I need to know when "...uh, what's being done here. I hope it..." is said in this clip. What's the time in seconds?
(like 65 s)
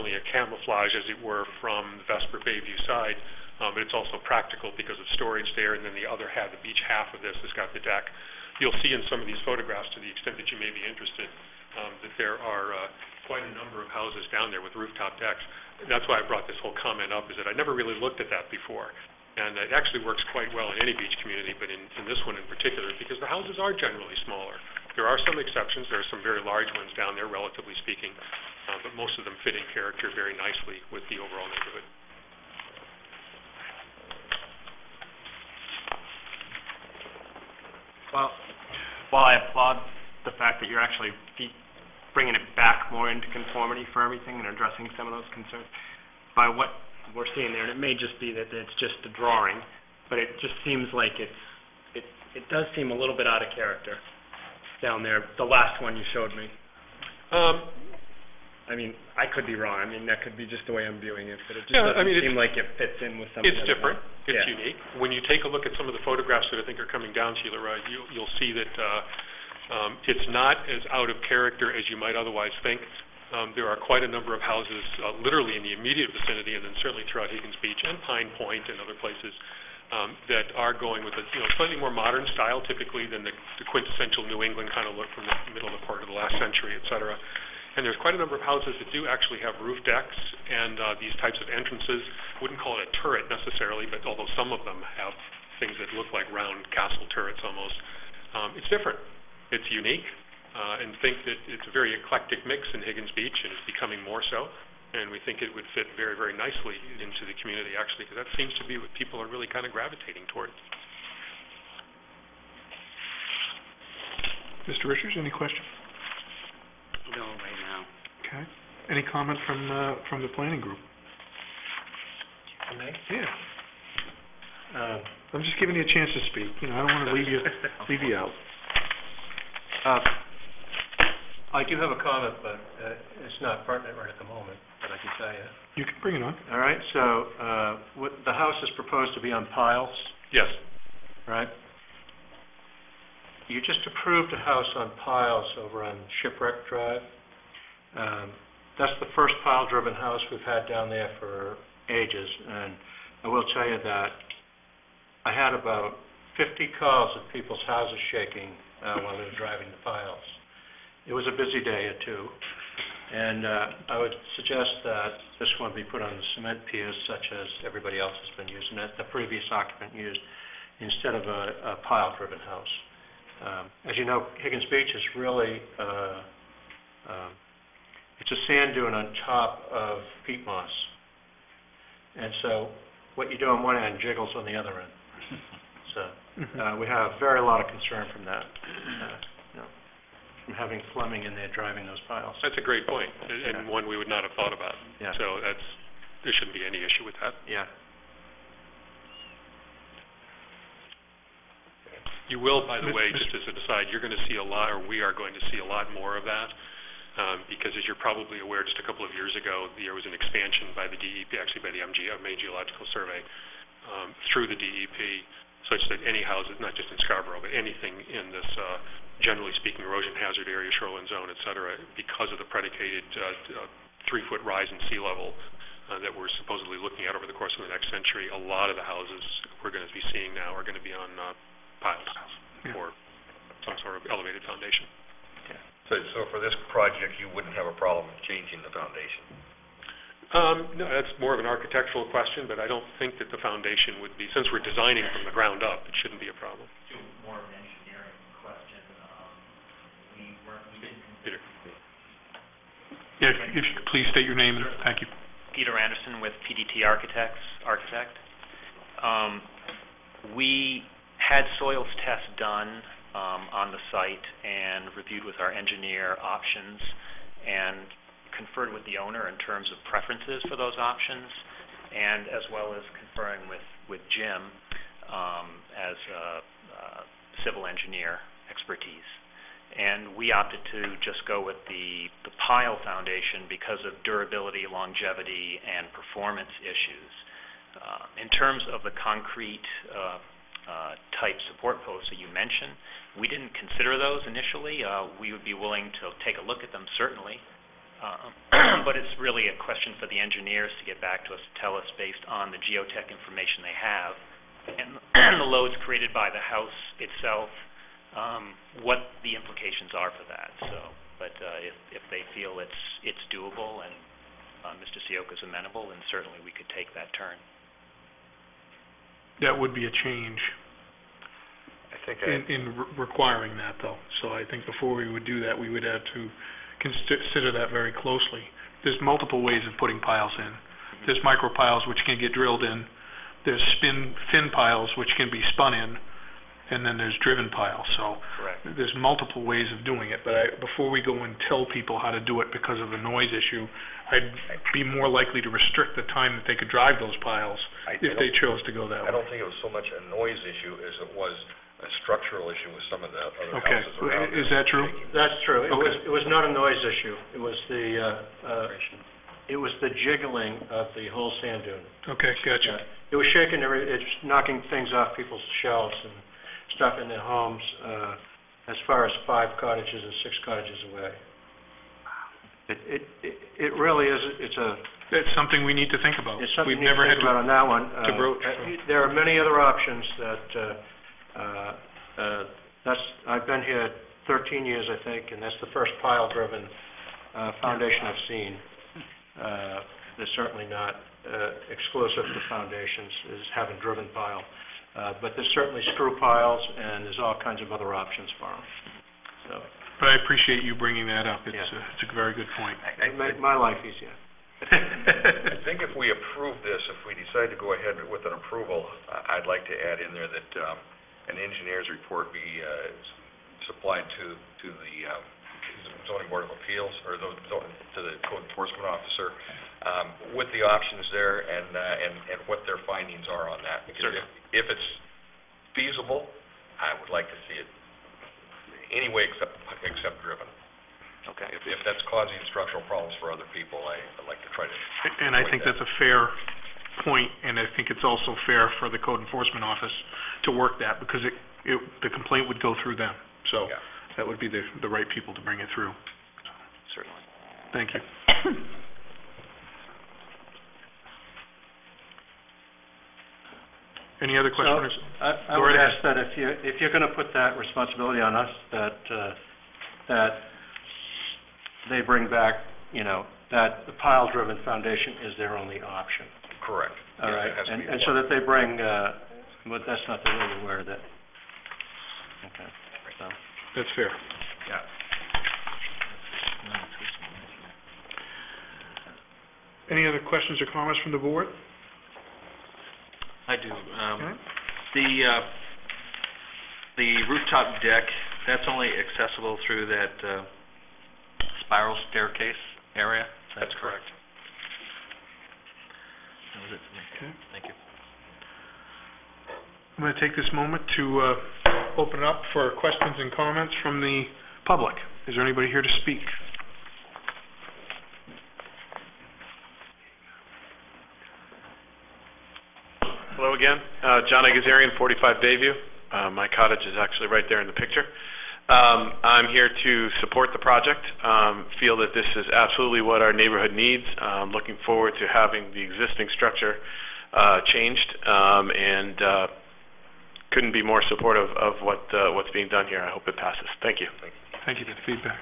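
532 s.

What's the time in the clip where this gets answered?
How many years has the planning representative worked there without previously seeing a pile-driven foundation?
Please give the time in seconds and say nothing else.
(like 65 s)
384 s.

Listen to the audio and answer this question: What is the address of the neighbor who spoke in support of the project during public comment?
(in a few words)
45 Bayview.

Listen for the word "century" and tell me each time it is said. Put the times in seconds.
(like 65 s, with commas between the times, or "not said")
86 s, 227 s.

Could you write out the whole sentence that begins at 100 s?
Uh, and think that it's a very eclectic mix in Higgins Beach, and it's becoming more so.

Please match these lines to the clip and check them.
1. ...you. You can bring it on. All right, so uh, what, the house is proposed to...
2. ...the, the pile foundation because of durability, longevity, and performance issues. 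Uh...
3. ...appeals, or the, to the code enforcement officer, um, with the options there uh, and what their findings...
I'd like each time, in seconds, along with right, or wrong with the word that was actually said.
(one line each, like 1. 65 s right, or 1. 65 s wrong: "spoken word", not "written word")
1. 135 s right
2. 281 s right
3. 416 s right.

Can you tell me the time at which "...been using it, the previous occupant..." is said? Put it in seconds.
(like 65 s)
168 s.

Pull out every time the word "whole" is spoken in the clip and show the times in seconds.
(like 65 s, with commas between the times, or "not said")
16 s, 361 s.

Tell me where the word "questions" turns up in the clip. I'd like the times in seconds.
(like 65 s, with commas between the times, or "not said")
115 s, 242 s, 299 s, 454 s, 480 s, 502 s.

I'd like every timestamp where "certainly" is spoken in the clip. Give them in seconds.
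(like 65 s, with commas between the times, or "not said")
76 s, 297 s, 316 s, 390 s, 395 s, 446 s.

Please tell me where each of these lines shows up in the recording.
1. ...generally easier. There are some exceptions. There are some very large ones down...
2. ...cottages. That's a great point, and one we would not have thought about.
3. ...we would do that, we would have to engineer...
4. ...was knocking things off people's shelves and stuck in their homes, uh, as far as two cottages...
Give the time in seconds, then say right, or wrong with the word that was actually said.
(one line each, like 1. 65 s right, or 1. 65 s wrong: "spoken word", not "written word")
1. 23 s wrong: "smaller", not "easier"
2. 192 s wrong: "piles", not "cottages"
3. 324 s wrong: "consider", not "engineer"
4. 363 s wrong: "five", not "two".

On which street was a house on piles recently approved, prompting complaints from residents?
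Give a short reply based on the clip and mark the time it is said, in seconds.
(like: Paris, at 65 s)
Shipwreck Drive, at 146 s.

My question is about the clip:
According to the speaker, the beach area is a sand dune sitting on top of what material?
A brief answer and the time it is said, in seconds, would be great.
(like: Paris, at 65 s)
Peat moss, at 180 s.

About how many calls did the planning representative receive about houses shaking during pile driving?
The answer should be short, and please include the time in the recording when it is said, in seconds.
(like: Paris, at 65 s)
50, at 156 s.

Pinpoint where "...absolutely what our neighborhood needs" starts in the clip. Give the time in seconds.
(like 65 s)
522 s.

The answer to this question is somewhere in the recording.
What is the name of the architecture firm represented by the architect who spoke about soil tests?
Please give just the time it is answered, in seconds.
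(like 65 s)
256 s.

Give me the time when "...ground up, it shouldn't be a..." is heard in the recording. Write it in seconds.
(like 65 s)
245 s.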